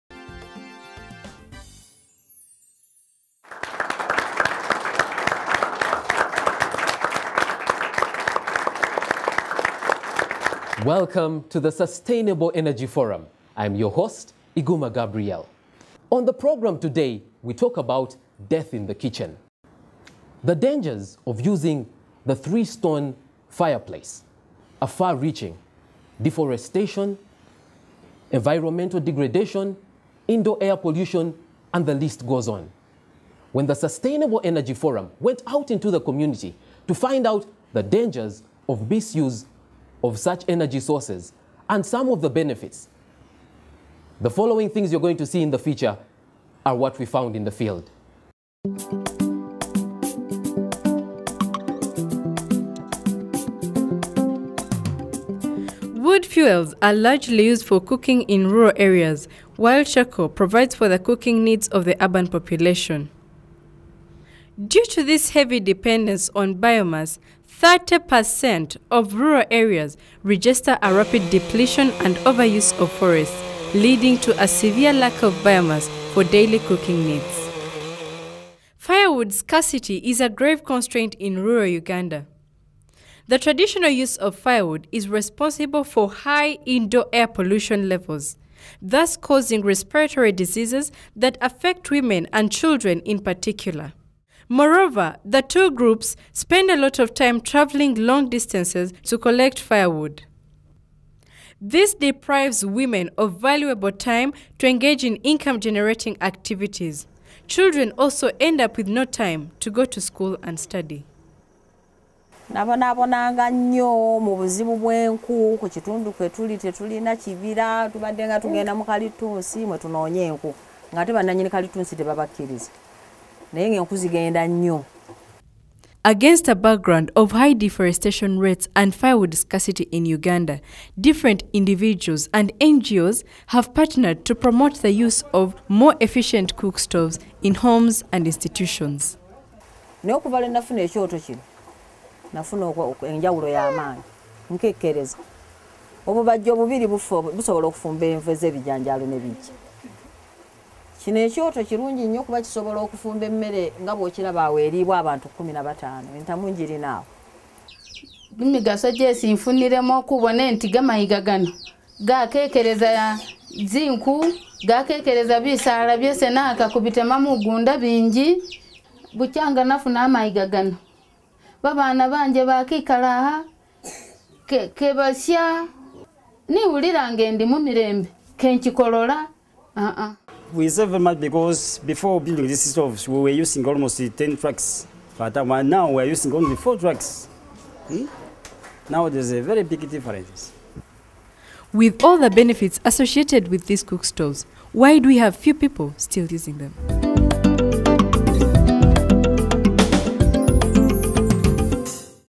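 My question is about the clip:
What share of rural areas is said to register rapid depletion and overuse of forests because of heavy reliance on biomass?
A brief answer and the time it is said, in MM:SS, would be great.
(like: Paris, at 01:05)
30%, at 01:07.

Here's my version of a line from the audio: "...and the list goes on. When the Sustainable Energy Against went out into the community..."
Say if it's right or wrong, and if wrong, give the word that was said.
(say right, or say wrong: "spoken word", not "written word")
wrong: "Forum", not "Against".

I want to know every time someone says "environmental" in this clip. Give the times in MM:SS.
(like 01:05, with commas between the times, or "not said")
00:28.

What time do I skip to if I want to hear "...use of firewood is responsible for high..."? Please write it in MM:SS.
01:23.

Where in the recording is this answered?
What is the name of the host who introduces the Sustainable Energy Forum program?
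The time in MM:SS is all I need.
00:14.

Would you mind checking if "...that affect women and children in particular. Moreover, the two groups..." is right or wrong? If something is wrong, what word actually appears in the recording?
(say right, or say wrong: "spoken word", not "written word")
right.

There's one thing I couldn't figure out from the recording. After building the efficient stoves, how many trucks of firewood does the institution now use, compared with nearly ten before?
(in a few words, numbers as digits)
4.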